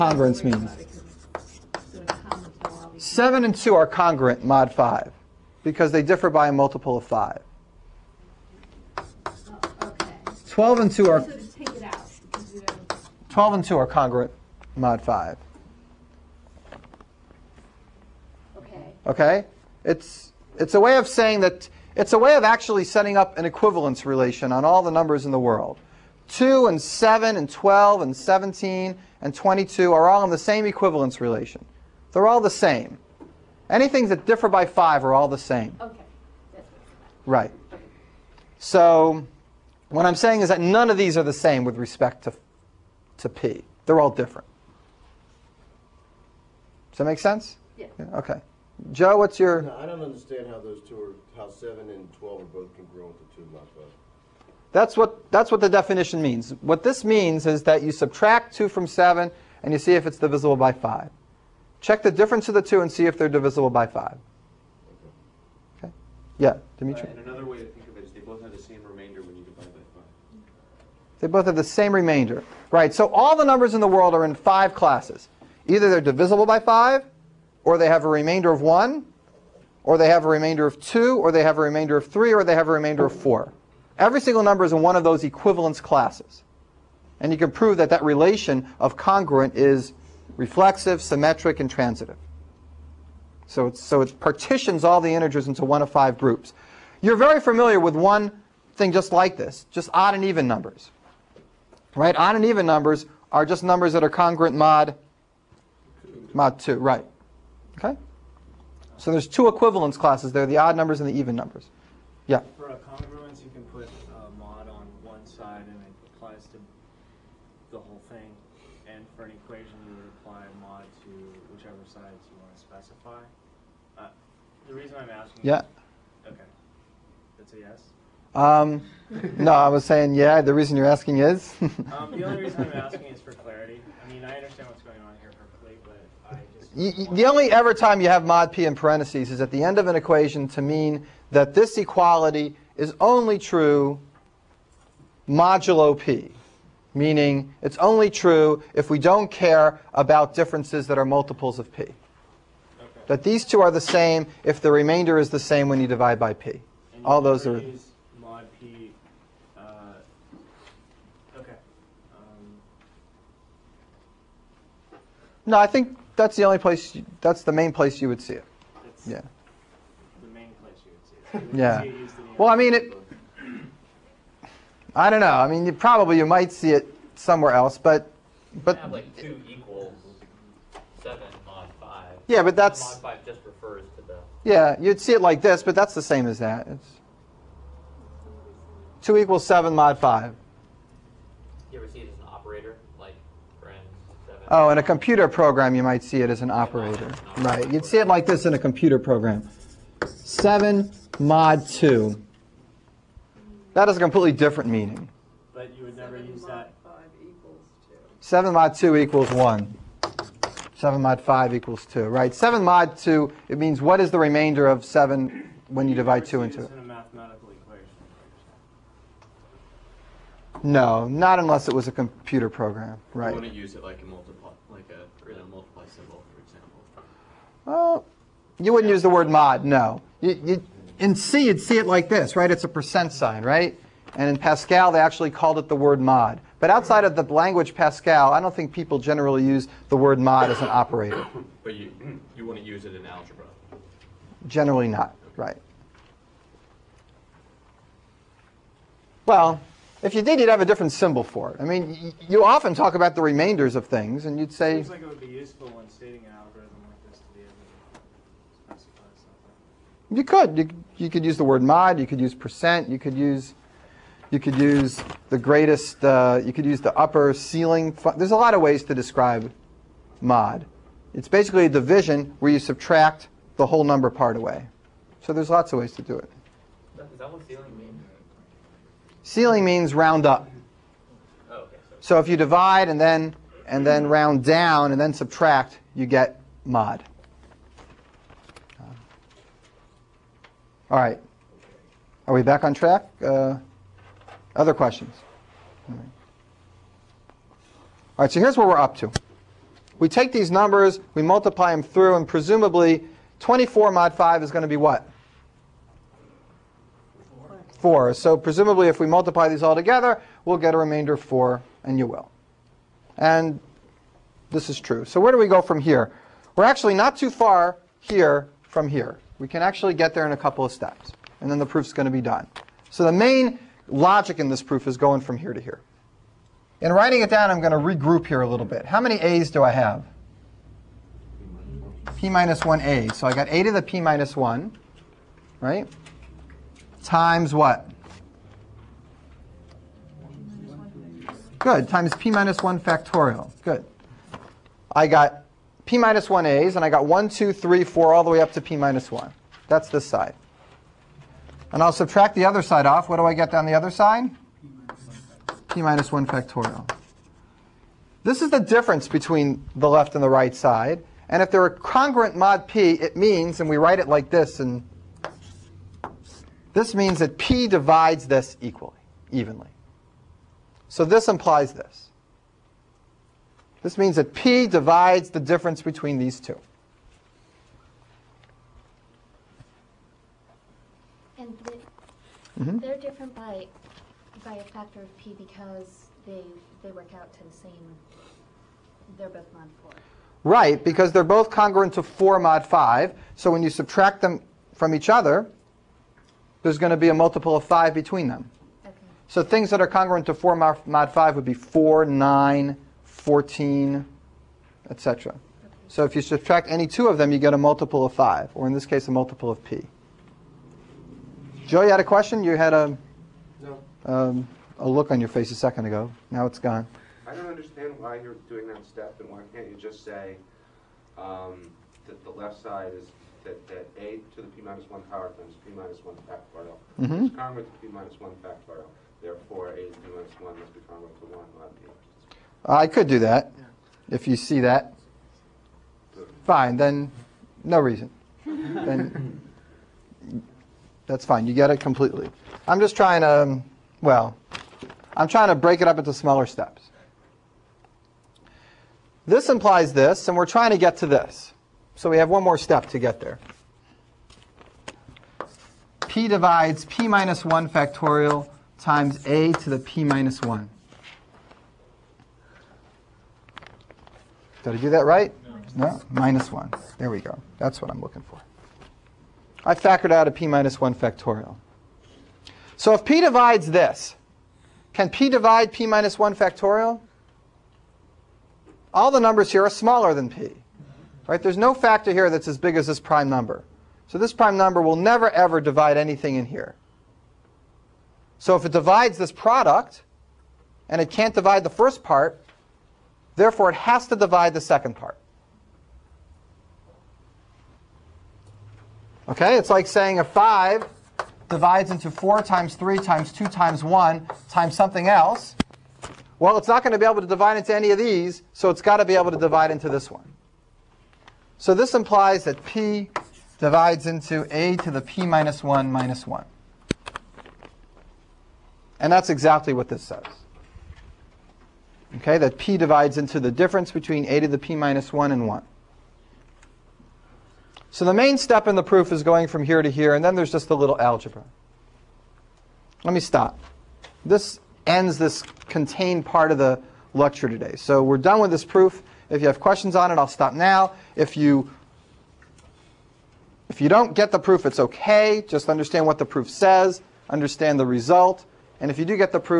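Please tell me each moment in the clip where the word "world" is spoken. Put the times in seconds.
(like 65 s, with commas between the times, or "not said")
25 s, 73 s.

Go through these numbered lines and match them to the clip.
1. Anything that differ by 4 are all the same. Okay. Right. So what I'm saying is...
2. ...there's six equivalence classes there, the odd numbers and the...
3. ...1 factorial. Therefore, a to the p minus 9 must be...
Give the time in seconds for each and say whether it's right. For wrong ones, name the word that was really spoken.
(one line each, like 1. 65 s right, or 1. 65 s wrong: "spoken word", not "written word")
1. 33 s wrong: "5", not "4"
2. 109 s wrong: "two", not "six"
3. 428 s wrong: "1", not "9".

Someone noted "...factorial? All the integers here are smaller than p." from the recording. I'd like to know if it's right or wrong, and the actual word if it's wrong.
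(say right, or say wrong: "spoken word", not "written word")
wrong: "numbers", not "integers".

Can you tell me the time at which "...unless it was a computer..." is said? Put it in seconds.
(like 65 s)
221 s.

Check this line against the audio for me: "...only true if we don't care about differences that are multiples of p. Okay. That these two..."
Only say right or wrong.
right.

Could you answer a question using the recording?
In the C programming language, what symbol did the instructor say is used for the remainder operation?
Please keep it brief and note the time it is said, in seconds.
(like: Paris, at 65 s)
percent sign, at 232 s.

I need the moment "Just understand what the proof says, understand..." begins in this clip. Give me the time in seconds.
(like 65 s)
545 s.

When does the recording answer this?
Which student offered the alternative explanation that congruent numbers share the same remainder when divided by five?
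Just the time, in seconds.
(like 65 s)
66 s.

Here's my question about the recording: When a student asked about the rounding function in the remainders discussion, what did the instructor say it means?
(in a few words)
round up.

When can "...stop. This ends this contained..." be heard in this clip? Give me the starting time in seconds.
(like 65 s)
533 s.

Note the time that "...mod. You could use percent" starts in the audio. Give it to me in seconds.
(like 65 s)
261 s.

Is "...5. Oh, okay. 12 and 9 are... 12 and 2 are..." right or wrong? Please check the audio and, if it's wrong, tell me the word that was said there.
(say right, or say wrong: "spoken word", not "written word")
wrong: "2", not "9".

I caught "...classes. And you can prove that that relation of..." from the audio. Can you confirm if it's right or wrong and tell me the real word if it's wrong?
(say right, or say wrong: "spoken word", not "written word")
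right.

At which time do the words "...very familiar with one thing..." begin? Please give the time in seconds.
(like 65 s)
97 s.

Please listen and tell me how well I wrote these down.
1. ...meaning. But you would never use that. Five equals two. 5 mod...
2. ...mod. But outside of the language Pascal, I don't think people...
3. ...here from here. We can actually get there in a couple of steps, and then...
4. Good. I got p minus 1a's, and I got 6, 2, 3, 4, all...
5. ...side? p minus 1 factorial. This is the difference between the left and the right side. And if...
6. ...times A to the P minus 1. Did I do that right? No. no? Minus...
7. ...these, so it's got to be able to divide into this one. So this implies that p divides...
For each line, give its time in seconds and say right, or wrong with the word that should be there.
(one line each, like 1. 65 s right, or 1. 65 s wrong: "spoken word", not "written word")
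1. 204 s wrong: "7", not "5"
2. 236 s right
3. 318 s right
4. 343 s wrong: "1", not "6"
5. 353 s right
6. 458 s right
7. 507 s right.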